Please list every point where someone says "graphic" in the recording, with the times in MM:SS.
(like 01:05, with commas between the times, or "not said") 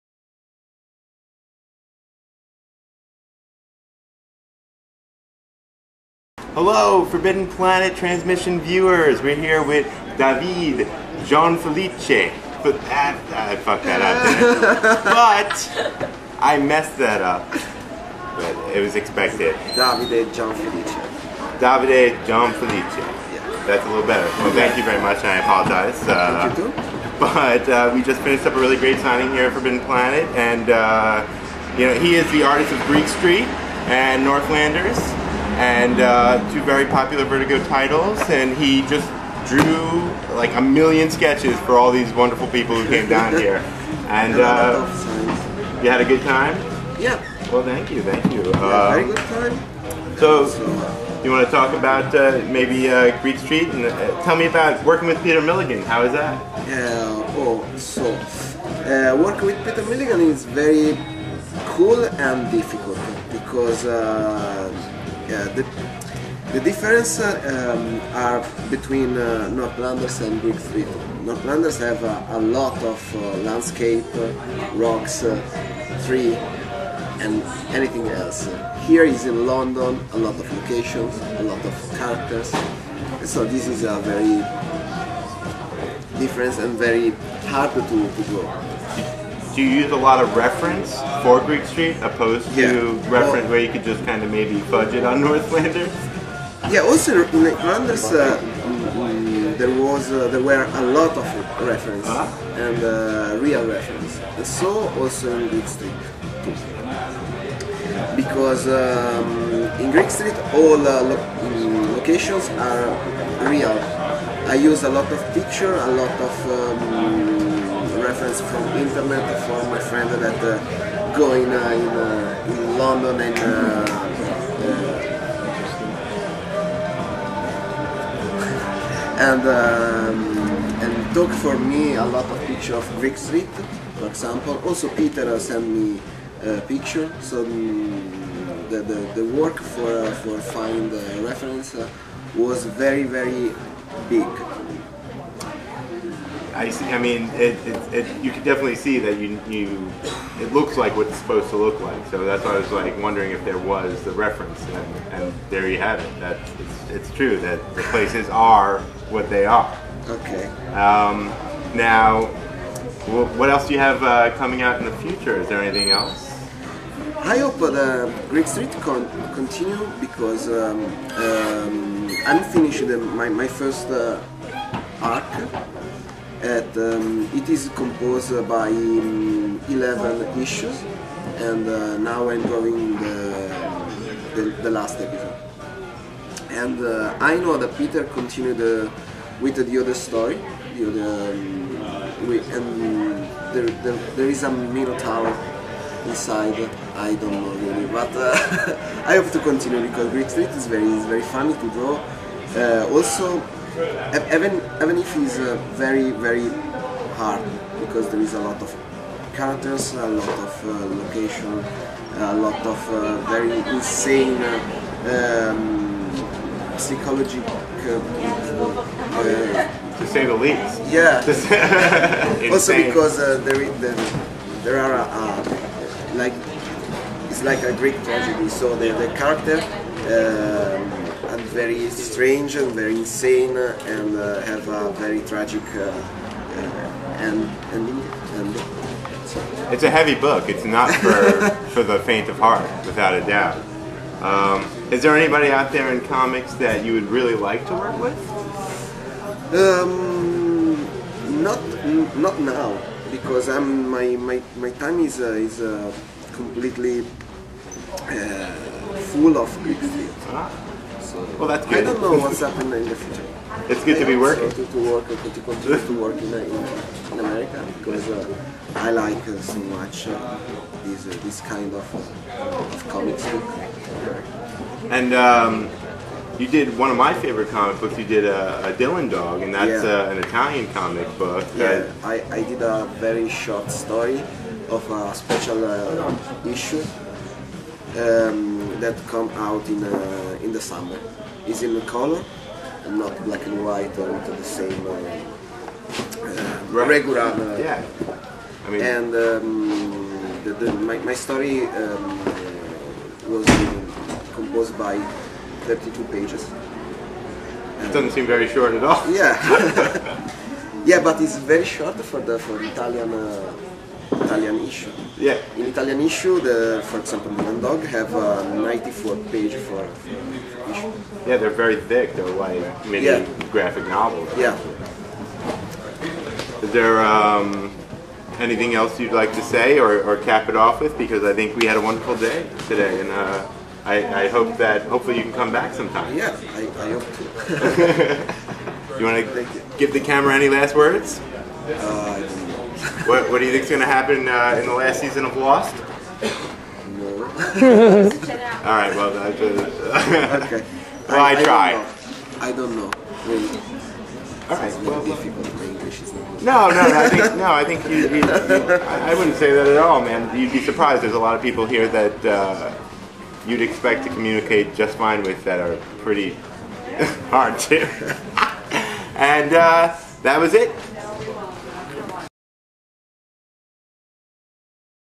05:23.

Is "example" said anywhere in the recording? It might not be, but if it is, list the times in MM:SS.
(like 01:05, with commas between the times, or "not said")
02:14, 05:16.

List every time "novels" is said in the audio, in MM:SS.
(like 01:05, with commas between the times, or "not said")
05:23.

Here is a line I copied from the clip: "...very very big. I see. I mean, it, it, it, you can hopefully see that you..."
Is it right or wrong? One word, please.
wrong.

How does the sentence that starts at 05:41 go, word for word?
Uh, what, what do you think is going to happen uh, in the last season of Lost?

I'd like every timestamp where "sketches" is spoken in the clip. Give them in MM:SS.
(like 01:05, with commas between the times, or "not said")
00:41.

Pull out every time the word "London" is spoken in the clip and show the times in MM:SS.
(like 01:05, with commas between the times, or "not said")
01:19, 02:02.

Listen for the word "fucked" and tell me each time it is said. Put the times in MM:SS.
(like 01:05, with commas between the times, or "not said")
00:13.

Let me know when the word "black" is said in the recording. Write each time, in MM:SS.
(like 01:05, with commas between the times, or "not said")
04:53.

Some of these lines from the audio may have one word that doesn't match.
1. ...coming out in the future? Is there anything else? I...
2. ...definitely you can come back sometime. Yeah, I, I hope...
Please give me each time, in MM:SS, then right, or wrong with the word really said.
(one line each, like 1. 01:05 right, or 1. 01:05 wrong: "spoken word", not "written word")
1. 02:44 right
2. 05:34 wrong: "hopefully", not "definitely".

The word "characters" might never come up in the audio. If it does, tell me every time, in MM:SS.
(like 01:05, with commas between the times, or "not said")
01:21, 03:29, 03:49.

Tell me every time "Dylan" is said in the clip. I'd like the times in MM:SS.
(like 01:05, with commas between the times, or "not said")
04:38, 05:17.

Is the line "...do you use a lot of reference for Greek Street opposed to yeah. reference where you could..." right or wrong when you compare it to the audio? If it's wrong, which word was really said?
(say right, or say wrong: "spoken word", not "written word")
right.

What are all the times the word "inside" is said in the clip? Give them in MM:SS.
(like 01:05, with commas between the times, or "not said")
03:16.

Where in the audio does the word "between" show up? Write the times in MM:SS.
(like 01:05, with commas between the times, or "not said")
01:08.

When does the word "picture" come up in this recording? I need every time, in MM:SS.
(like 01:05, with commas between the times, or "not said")
01:55, 02:12, 02:16.